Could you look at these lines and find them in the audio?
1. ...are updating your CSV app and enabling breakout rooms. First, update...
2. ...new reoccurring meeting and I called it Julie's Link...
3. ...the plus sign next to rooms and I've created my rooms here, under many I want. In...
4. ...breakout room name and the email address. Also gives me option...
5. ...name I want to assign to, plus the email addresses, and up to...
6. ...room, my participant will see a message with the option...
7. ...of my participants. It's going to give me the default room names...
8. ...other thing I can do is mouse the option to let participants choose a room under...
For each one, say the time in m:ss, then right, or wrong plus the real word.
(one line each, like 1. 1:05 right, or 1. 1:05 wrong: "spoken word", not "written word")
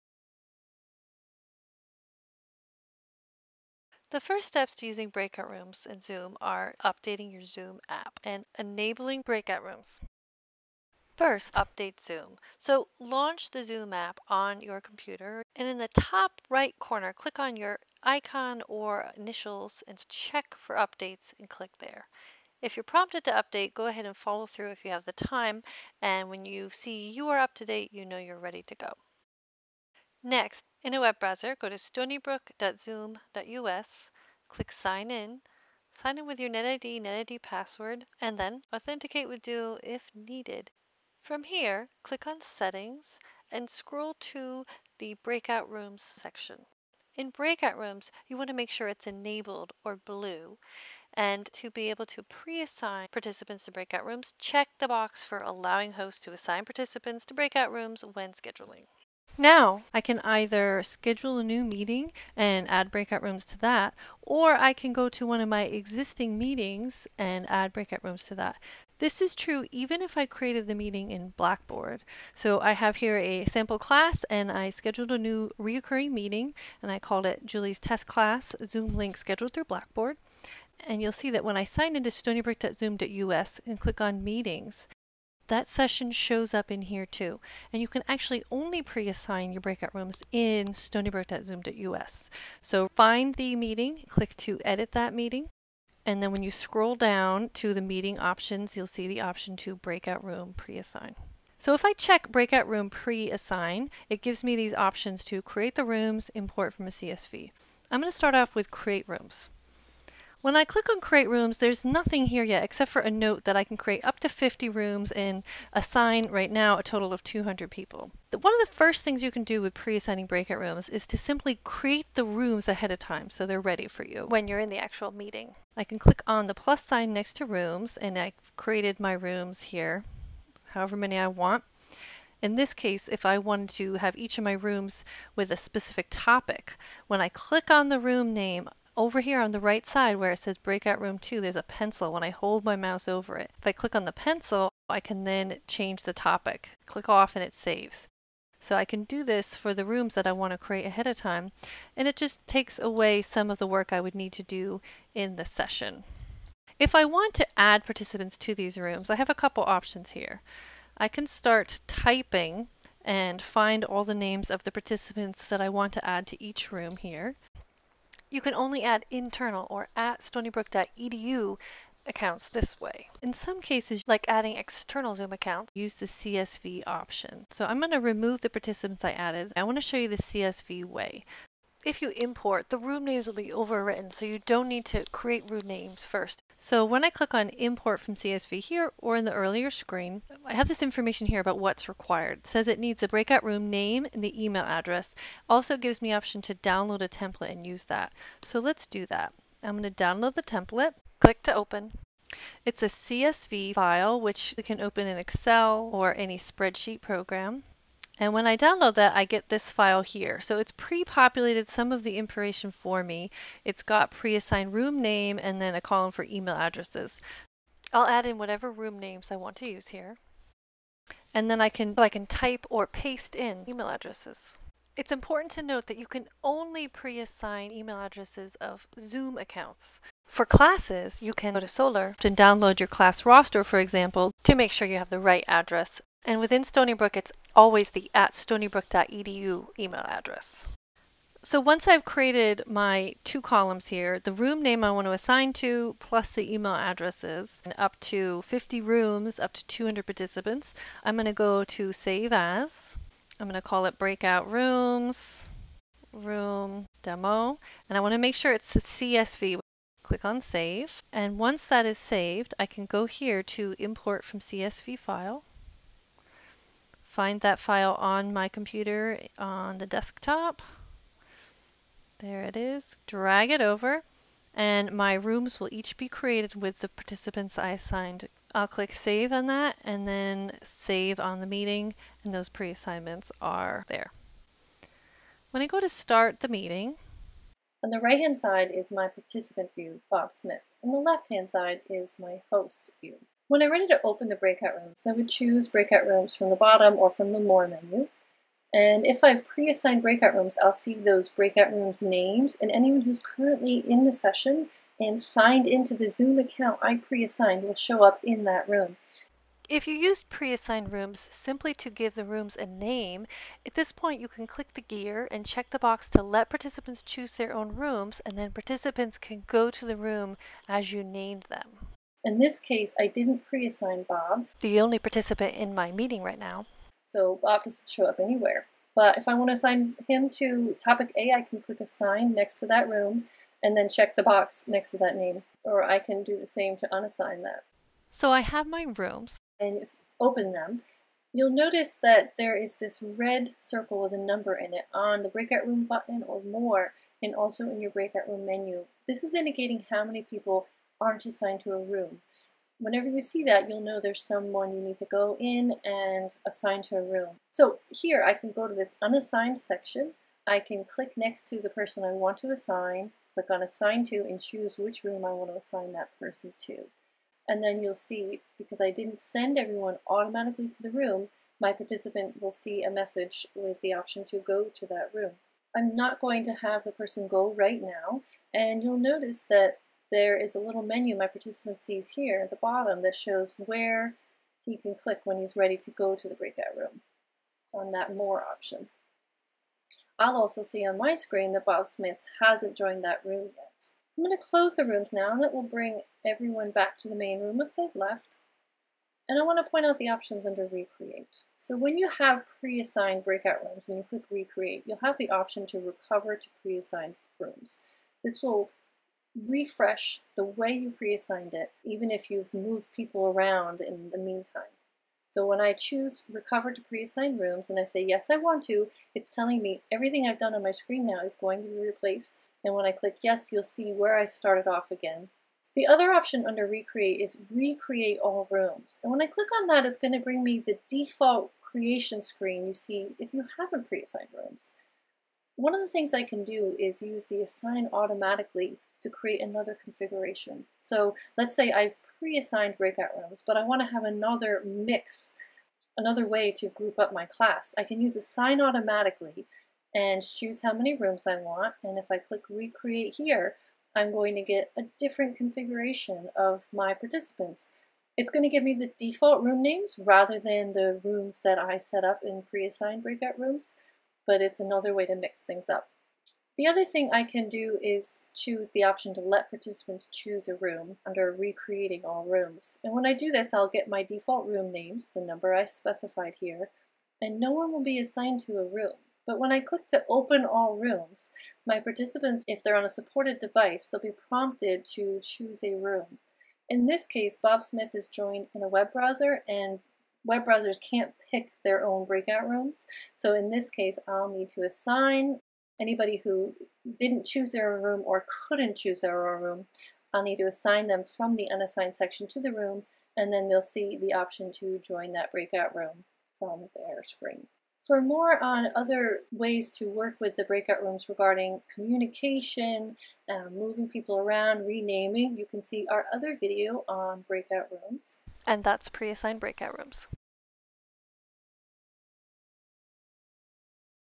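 1. 0:06 wrong: "Zoom", not "CSV"
2. 1:15 wrong: "Test", not "Link"
3. 2:06 wrong: "however", not "under"
4. 3:13 right
5. 4:04 right
6. 6:10 right
7. 7:36 right
8. 7:46 wrong: "choose", not "mouse".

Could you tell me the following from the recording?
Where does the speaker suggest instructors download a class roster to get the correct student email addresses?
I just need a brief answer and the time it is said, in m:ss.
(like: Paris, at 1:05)
Solar, at 3:51.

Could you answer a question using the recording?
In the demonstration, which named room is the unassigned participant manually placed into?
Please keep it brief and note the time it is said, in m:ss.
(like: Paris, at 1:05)
Topic A, at 5:30.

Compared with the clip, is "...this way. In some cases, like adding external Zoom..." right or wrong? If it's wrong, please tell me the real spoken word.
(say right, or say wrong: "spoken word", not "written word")
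right.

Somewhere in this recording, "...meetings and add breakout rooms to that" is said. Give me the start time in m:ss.
1:06.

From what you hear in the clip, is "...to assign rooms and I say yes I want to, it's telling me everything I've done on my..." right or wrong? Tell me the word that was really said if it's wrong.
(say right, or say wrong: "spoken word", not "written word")
wrong: "preassign", not "assign".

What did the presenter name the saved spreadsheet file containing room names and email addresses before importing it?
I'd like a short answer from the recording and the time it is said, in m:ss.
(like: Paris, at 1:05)
Breakout Rooms, Room Demo, at 4:13.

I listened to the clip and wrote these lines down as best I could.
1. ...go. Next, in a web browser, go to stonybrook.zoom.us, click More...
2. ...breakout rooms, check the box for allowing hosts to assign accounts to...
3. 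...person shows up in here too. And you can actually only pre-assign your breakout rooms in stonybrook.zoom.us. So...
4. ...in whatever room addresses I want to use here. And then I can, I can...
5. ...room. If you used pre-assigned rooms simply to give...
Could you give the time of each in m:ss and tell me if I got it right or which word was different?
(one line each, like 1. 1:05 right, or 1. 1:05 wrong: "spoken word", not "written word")
1. 0:28 wrong: "Sign", not "More"
2. 0:53 wrong: "participants", not "accounts"
3. 1:25 wrong: "session", not "person"
4. 3:38 wrong: "names", not "addresses"
5. 5:08 right.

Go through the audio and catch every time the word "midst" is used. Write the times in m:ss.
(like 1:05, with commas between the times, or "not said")
not said.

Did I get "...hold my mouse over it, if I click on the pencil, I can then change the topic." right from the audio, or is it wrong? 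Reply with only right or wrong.
right.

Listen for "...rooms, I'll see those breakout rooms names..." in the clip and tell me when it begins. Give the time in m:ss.
5:00.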